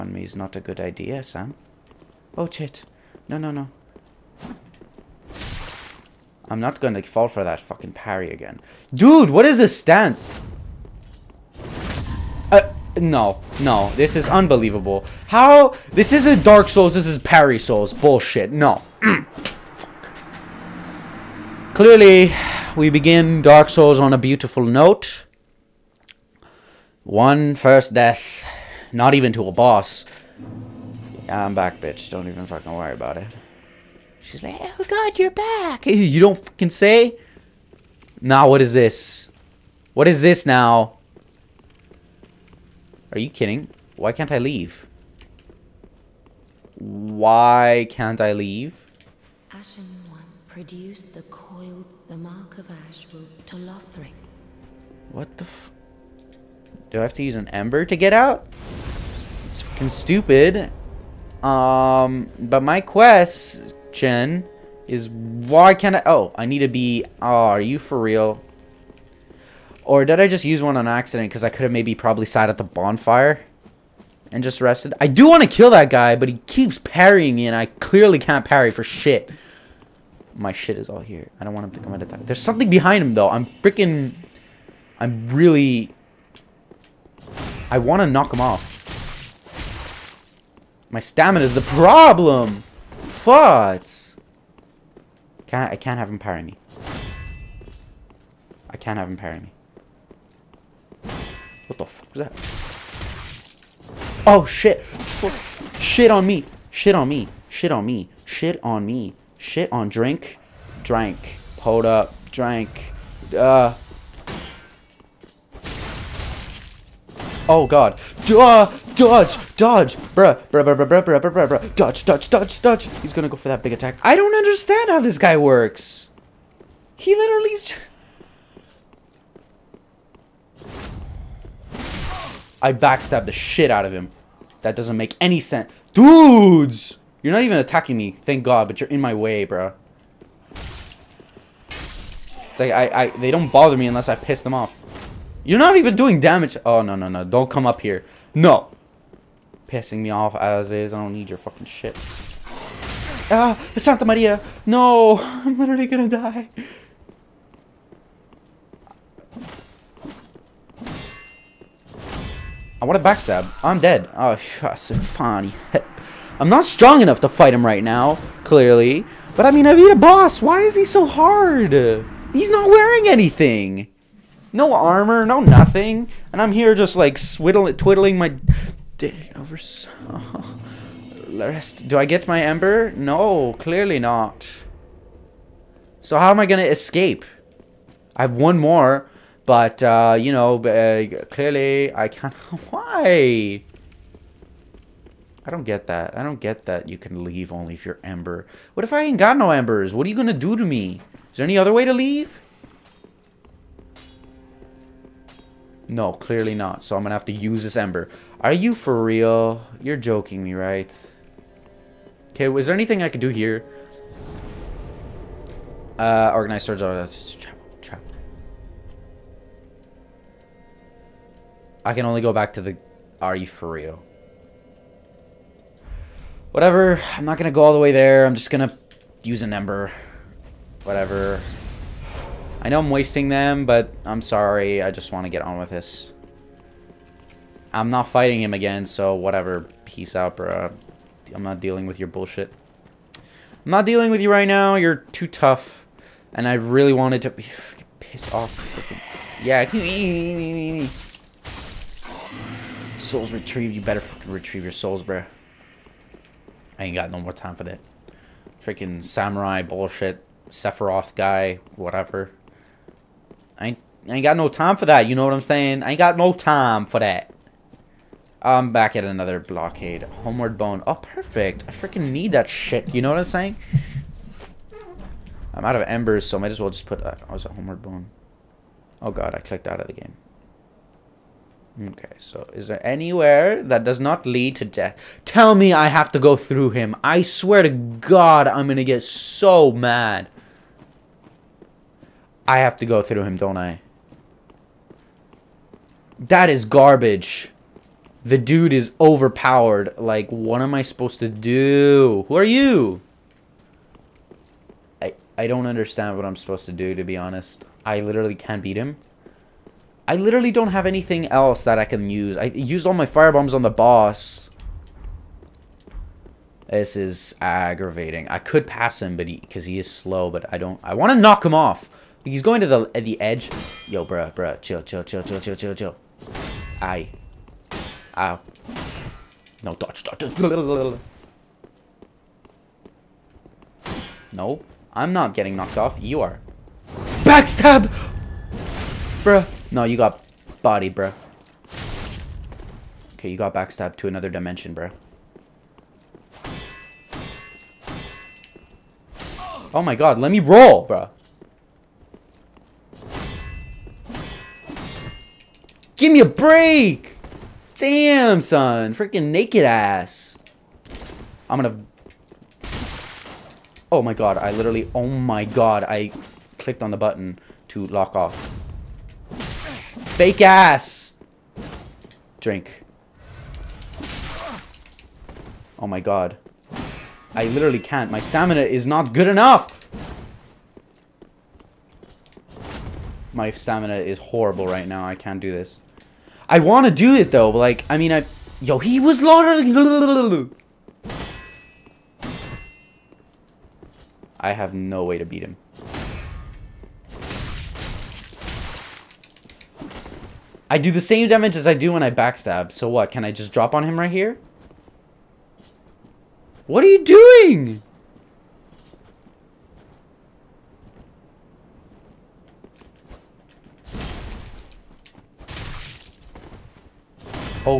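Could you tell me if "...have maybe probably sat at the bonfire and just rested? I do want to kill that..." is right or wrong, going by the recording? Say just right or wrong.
right.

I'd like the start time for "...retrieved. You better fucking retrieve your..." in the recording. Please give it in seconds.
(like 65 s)
253 s.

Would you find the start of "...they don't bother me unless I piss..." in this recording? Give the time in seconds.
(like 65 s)
143 s.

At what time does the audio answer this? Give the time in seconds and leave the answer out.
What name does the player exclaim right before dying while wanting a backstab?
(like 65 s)
153 s.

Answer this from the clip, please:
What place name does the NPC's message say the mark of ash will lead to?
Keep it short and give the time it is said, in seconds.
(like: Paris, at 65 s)
Lothric, at 53 s.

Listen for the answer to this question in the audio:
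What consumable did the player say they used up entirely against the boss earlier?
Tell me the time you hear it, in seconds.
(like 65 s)
313 s.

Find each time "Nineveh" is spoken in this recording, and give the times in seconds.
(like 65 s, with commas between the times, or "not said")
not said.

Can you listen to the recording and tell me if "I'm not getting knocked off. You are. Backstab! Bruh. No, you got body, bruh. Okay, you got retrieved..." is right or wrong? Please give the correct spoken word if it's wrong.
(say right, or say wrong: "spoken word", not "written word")
wrong: "backstabbed", not "retrieved".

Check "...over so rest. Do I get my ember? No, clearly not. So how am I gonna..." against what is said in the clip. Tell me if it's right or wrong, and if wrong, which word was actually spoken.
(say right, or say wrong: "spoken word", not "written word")
right.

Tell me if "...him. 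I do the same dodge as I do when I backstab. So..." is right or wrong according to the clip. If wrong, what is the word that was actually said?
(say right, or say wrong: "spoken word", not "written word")
wrong: "damage", not "dodge".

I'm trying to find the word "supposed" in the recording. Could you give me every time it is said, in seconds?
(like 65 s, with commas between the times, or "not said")
300 s, 306 s.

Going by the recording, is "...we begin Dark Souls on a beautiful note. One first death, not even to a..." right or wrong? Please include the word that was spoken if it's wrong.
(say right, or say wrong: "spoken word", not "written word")
right.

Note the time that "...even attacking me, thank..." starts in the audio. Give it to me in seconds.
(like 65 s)
137 s.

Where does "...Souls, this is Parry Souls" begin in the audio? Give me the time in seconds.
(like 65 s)
16 s.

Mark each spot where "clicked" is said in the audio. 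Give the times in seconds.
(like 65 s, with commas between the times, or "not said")
279 s, 366 s.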